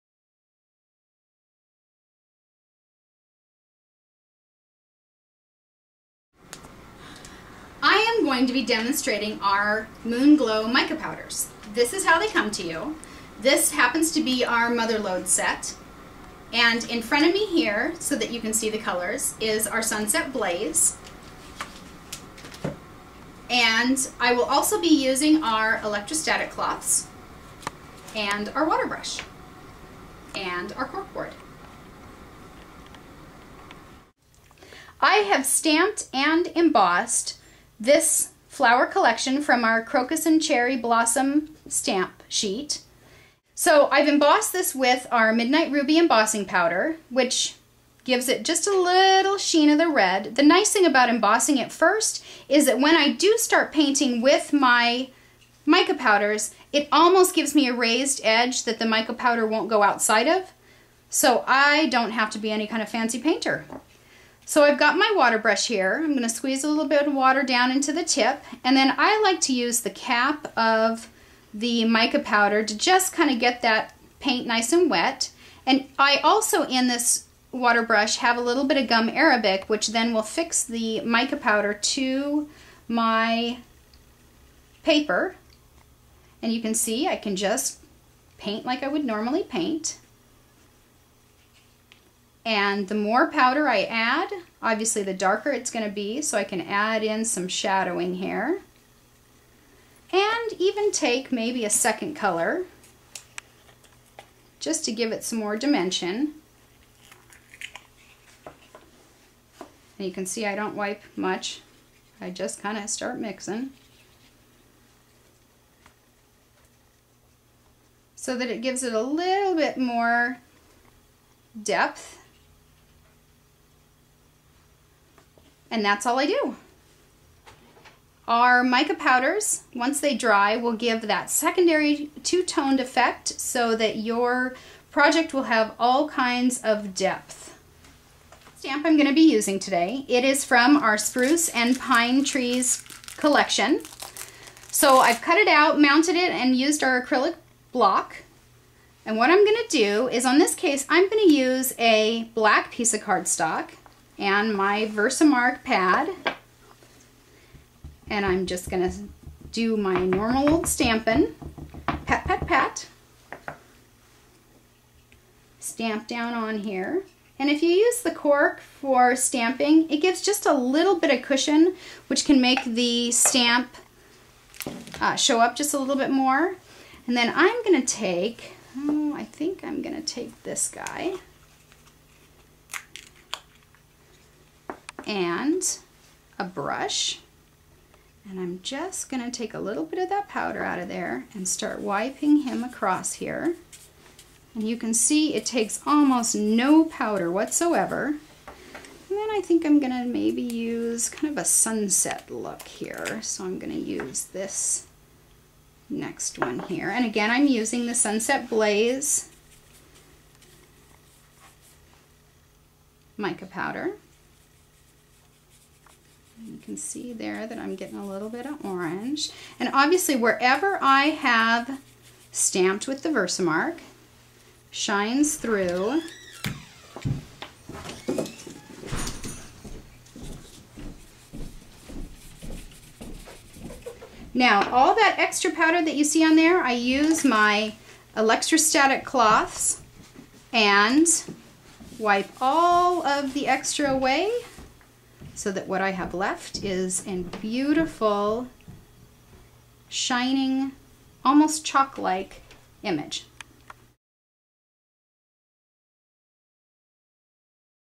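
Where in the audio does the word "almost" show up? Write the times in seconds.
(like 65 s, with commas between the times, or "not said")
56 s, 195 s, 251 s.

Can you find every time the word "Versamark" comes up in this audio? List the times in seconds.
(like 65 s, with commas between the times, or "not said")
154 s, 223 s.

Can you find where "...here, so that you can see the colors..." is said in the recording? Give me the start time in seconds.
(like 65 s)
17 s.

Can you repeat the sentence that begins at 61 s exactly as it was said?
So I don't have to be any kind of fancy painter.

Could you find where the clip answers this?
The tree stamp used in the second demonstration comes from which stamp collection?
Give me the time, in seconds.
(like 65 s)
140 s.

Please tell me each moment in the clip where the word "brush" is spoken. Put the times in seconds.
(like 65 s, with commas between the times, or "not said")
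28 s, 65 s, 77 s, 186 s.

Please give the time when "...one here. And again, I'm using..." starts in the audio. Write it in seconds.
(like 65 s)
206 s.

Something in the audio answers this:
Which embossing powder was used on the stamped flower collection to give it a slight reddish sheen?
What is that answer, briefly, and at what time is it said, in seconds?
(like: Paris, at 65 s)
Midnight Ruby, at 45 s.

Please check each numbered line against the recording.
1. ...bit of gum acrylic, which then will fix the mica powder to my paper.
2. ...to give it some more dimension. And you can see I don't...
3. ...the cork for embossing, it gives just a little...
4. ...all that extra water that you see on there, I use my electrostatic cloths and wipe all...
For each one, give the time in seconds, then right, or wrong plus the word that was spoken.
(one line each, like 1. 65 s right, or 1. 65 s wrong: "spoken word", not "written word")
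1. 78 s wrong: "arabic", not "acrylic"
2. 104 s right
3. 168 s wrong: "stamping", not "embossing"
4. 234 s wrong: "powder", not "water".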